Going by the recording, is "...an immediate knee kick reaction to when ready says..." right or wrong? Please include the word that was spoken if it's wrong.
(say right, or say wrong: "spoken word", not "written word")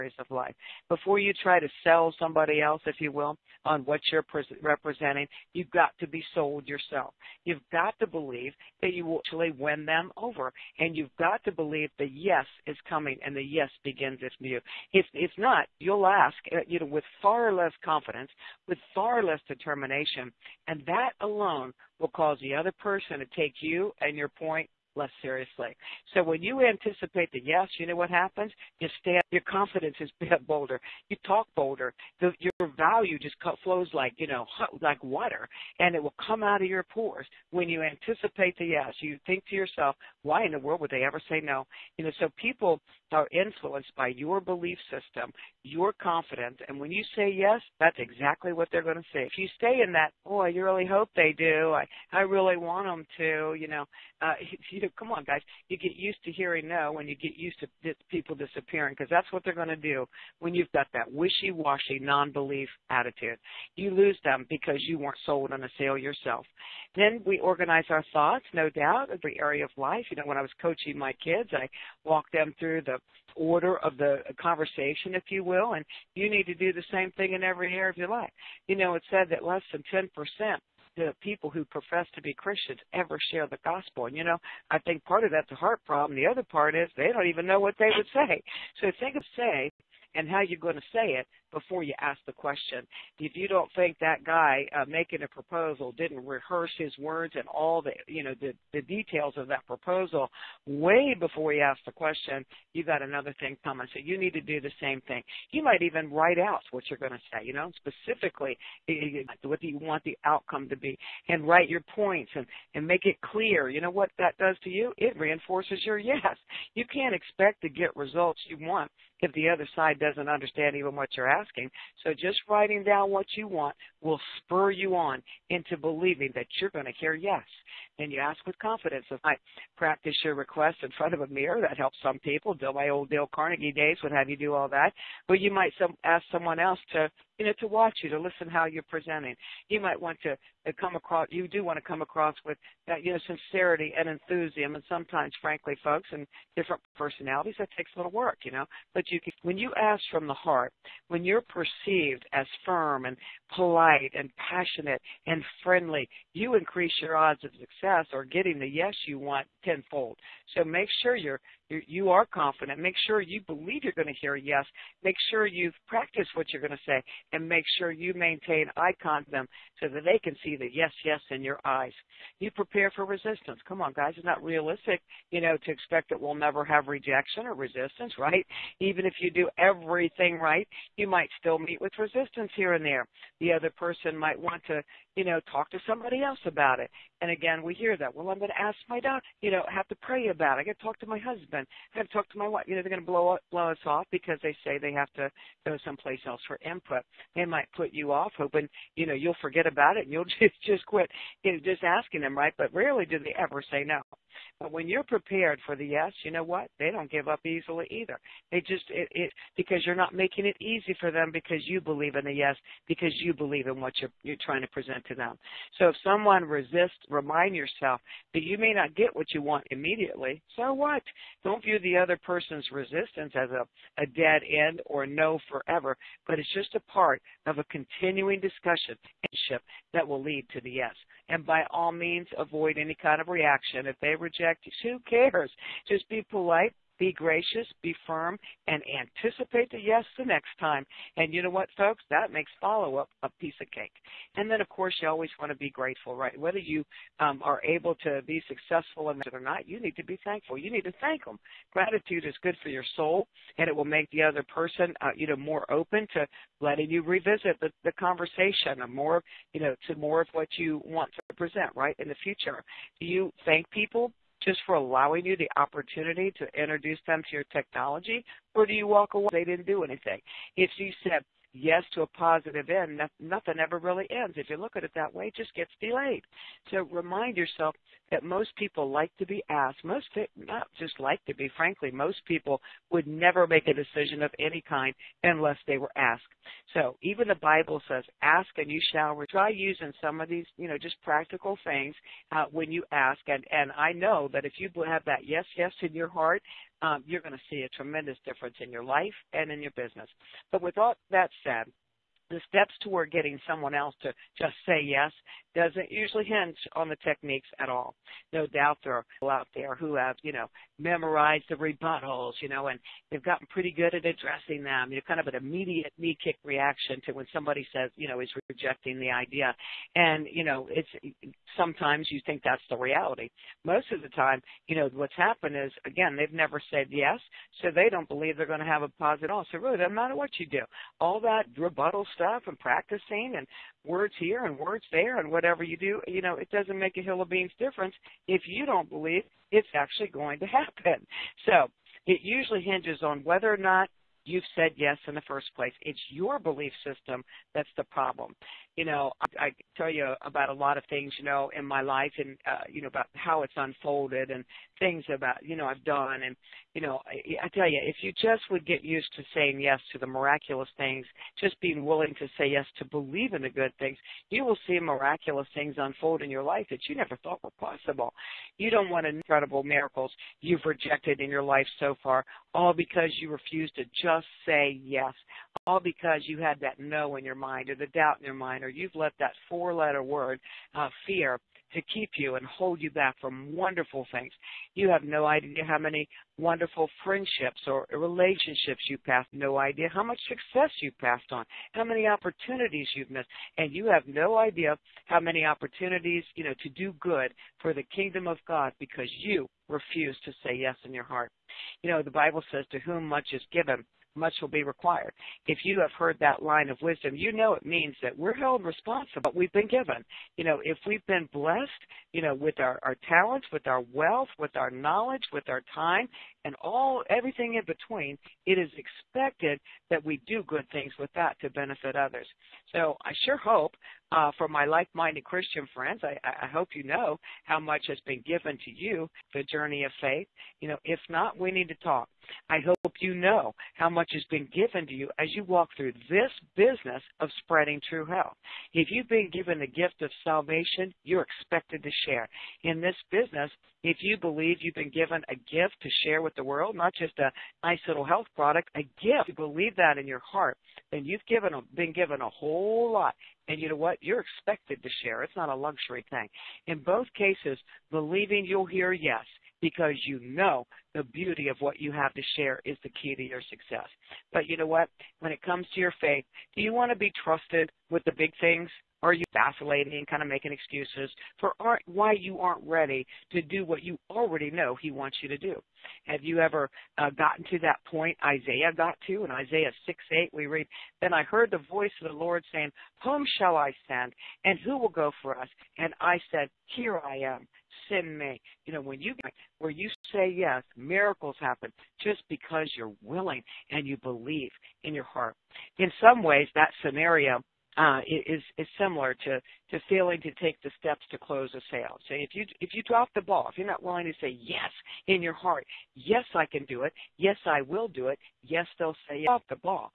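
wrong: "somebody", not "ready".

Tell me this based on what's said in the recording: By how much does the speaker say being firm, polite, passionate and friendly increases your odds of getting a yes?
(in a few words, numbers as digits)
tenfold.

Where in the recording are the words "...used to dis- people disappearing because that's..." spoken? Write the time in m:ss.
0:57.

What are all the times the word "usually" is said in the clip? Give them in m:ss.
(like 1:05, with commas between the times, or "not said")
5:05, 5:42.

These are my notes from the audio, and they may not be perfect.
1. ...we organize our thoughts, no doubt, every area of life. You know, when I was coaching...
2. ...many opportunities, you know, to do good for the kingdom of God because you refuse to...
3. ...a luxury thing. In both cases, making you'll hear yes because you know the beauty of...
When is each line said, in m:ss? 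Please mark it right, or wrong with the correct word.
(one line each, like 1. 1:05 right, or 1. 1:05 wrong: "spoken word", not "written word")
1. 1:07 right
2. 6:35 right
3. 7:35 wrong: "believing", not "making".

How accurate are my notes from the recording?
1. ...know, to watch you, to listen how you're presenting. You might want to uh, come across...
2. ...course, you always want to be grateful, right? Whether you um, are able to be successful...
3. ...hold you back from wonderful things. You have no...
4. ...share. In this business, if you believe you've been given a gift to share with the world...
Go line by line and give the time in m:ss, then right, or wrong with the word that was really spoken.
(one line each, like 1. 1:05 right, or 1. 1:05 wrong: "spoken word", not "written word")
1. 2:17 right
2. 4:04 right
3. 6:22 right
4. 7:22 right.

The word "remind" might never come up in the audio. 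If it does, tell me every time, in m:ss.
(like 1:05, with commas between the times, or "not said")
3:37, 4:36.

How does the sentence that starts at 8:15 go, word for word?
In some ways, that scenario uh, is is similar to to failing to take the steps to close a sale.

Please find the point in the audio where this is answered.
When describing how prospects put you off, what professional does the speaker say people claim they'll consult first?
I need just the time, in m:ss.
3:09.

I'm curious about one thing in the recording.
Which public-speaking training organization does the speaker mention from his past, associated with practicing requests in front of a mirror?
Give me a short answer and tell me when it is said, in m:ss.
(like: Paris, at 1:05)
Dale Carnegie, at 2:13.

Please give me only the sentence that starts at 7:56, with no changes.
Have you ever uh, gotten to that point Isaiah got to?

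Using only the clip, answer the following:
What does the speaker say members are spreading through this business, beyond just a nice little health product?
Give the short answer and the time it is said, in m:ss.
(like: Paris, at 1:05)
true health, at 7:17.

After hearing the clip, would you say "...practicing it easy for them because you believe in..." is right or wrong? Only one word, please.
wrong.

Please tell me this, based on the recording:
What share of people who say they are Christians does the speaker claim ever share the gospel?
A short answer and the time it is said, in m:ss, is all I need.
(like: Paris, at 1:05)
less than 10%, at 1:19.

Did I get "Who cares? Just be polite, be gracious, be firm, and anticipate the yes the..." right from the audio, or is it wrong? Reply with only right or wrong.
right.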